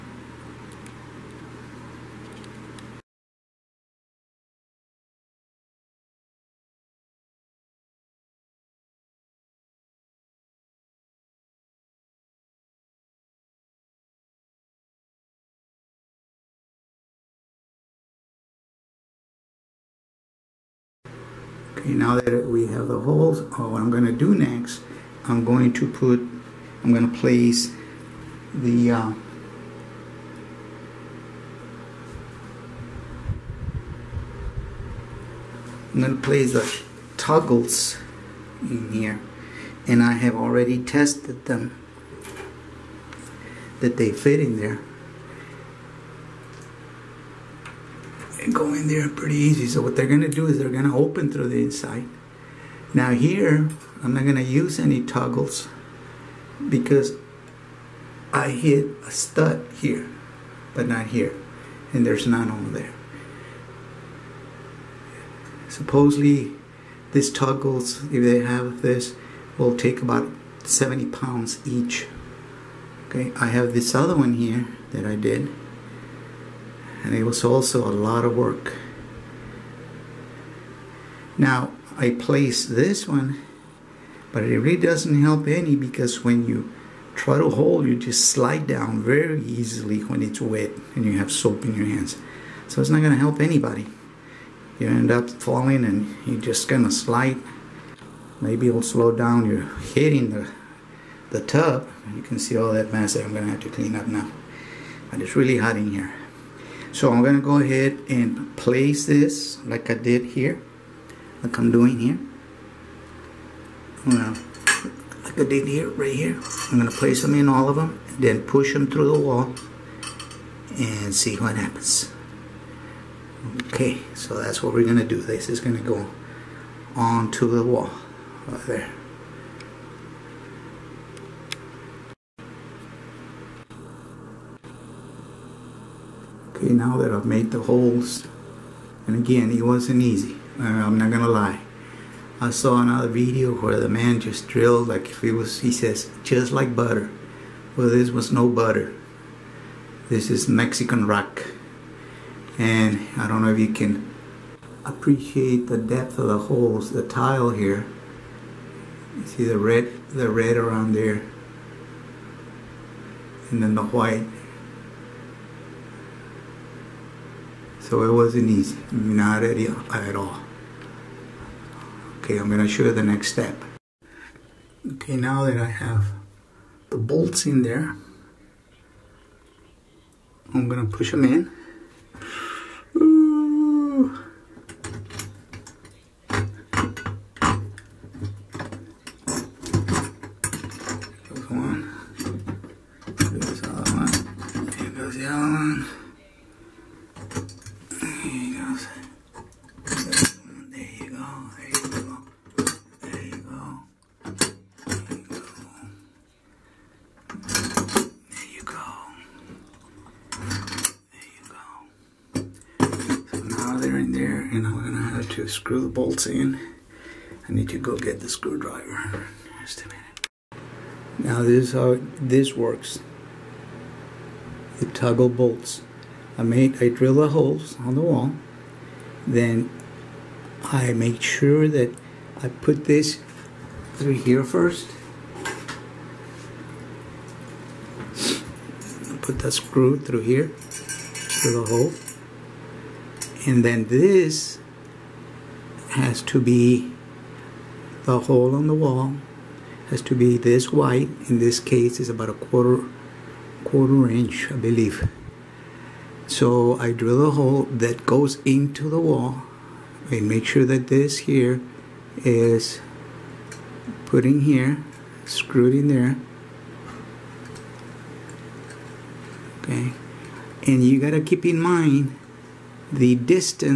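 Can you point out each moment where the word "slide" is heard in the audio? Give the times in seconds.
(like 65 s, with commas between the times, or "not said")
88 s, 96 s.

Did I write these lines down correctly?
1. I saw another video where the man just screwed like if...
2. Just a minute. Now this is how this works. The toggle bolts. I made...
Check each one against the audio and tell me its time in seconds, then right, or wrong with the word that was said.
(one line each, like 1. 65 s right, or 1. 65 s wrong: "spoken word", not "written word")
1. 142 s wrong: "drilled", not "screwed"
2. 219 s right.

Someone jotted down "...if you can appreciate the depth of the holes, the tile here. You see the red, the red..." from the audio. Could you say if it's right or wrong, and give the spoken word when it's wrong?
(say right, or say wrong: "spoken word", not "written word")
right.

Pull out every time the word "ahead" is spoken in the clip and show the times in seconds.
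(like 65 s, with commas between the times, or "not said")
107 s.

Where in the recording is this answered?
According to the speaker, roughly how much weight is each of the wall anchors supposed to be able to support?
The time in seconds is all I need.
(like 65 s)
70 s.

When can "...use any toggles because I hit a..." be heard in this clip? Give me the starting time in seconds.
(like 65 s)
54 s.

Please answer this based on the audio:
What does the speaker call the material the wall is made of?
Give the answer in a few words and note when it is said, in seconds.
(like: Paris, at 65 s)
Mexican rock, at 150 s.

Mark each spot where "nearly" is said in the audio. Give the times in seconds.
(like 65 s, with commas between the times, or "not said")
not said.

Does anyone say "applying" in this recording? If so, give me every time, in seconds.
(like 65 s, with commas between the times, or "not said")
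not said.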